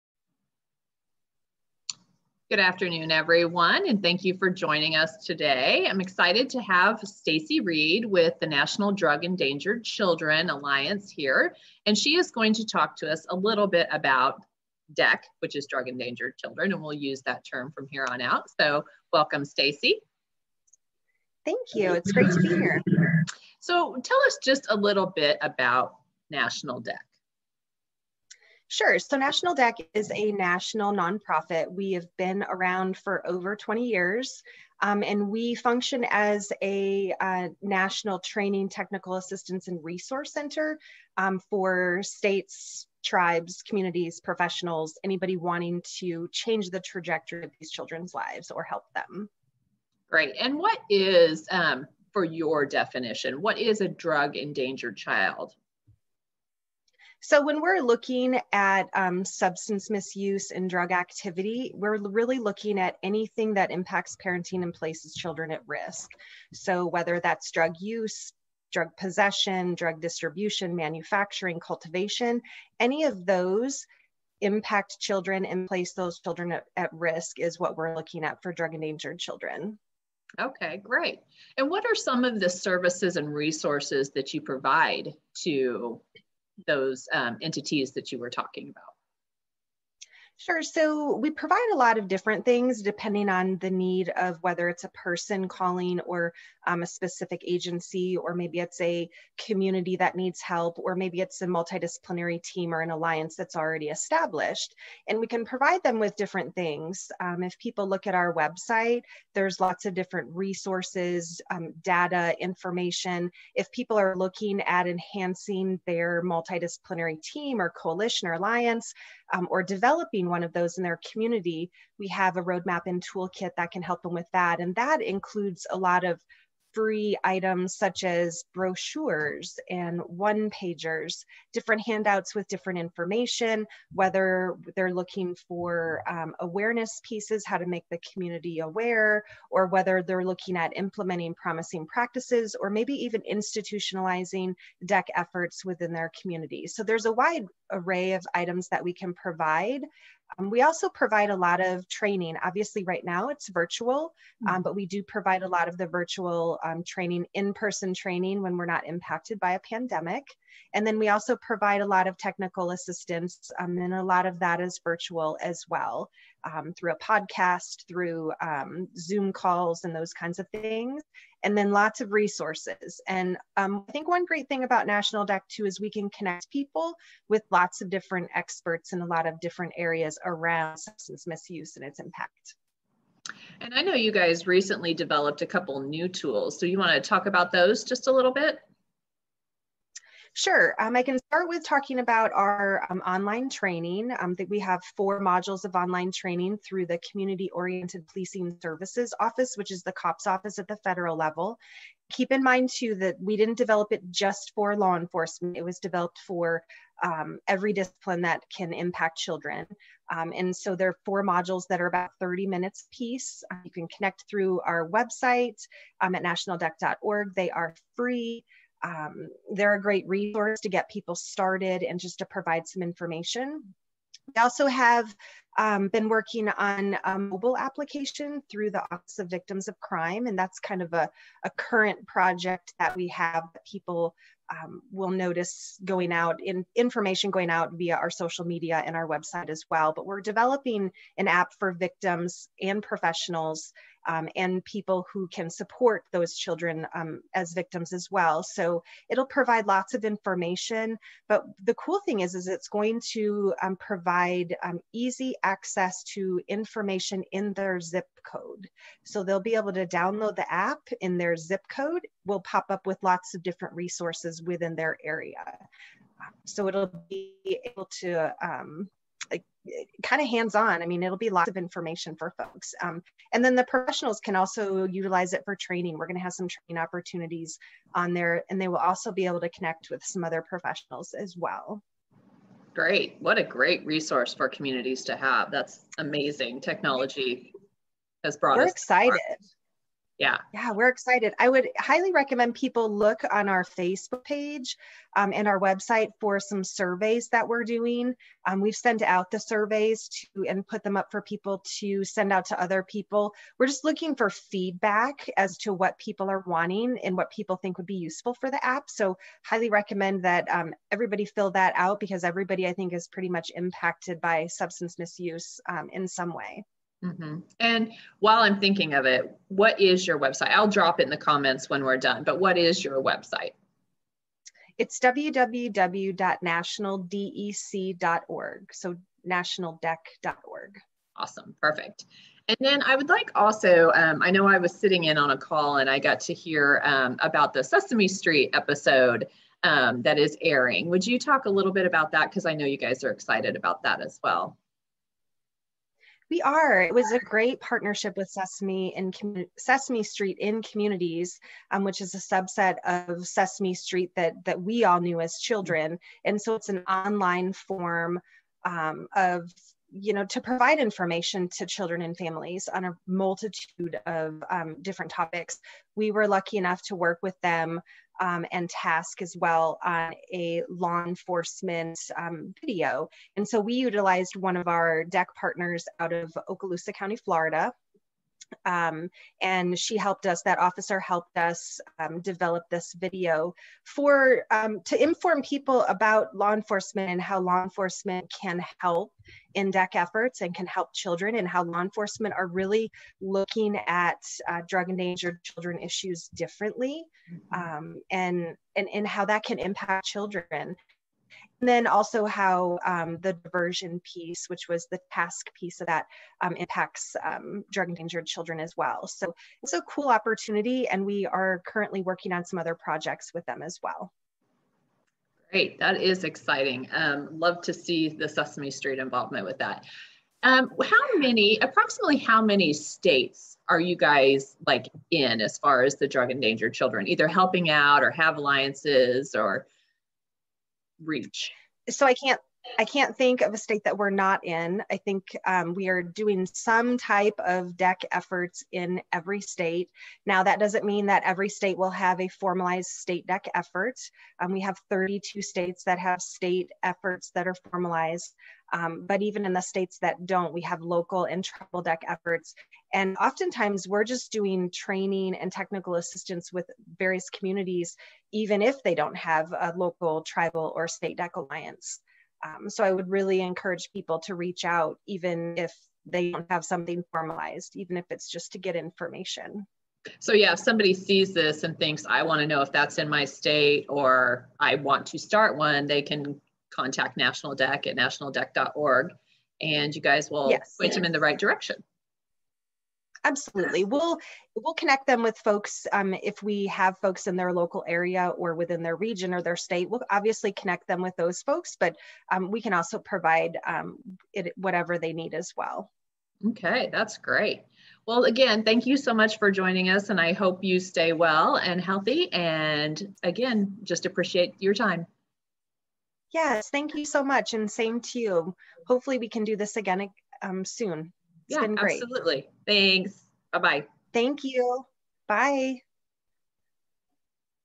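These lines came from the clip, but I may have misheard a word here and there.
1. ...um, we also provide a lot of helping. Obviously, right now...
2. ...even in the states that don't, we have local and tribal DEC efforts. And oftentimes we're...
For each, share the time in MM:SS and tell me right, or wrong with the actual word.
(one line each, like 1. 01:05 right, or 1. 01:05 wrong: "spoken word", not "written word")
1. 02:30 wrong: "training", not "helping"
2. 07:29 right.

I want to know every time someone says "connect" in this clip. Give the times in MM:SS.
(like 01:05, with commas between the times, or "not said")
02:56, 03:33, 04:39, 08:04, 08:10.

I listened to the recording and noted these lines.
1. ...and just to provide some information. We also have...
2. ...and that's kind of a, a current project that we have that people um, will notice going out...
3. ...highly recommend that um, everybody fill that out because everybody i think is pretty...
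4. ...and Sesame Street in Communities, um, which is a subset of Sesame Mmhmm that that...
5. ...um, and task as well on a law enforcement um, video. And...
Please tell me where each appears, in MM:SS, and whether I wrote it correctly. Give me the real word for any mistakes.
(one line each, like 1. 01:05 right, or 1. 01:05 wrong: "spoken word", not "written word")
1. 03:41 right
2. 03:50 right
3. 05:09 right
4. 05:48 wrong: "Street", not "Mmhmm"
5. 06:08 right.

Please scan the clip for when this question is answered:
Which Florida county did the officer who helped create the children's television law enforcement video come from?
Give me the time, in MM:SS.
06:16.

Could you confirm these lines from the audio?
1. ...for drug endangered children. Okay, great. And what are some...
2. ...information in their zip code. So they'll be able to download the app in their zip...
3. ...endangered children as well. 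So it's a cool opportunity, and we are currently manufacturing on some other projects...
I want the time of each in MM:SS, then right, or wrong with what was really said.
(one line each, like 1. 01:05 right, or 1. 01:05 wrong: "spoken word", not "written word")
1. 01:18 right
2. 04:16 right
3. 06:47 wrong: "working", not "manufacturing".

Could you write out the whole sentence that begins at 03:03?
And I know you guys recently developed a couple new tools.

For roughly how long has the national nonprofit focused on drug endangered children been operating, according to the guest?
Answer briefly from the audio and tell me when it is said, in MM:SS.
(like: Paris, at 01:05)
over 20 years, at 00:33.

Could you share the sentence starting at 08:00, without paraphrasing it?
point them in the right direction.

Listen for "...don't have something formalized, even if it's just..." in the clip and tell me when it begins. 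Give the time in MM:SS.
07:46.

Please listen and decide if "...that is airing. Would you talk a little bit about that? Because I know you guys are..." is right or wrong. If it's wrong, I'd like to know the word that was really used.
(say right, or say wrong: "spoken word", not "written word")
right.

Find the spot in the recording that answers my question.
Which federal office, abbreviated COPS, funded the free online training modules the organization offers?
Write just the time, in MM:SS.
03:17.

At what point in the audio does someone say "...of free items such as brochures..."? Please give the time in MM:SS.
02:06.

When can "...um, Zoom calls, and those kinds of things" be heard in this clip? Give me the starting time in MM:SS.
02:48.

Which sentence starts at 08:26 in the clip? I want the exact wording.
Yes, thank you so much, and same to you.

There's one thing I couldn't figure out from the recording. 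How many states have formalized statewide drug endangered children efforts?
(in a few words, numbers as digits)
32.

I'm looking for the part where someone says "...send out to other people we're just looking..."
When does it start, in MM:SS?
05:02.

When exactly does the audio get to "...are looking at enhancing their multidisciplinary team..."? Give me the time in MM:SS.
01:53.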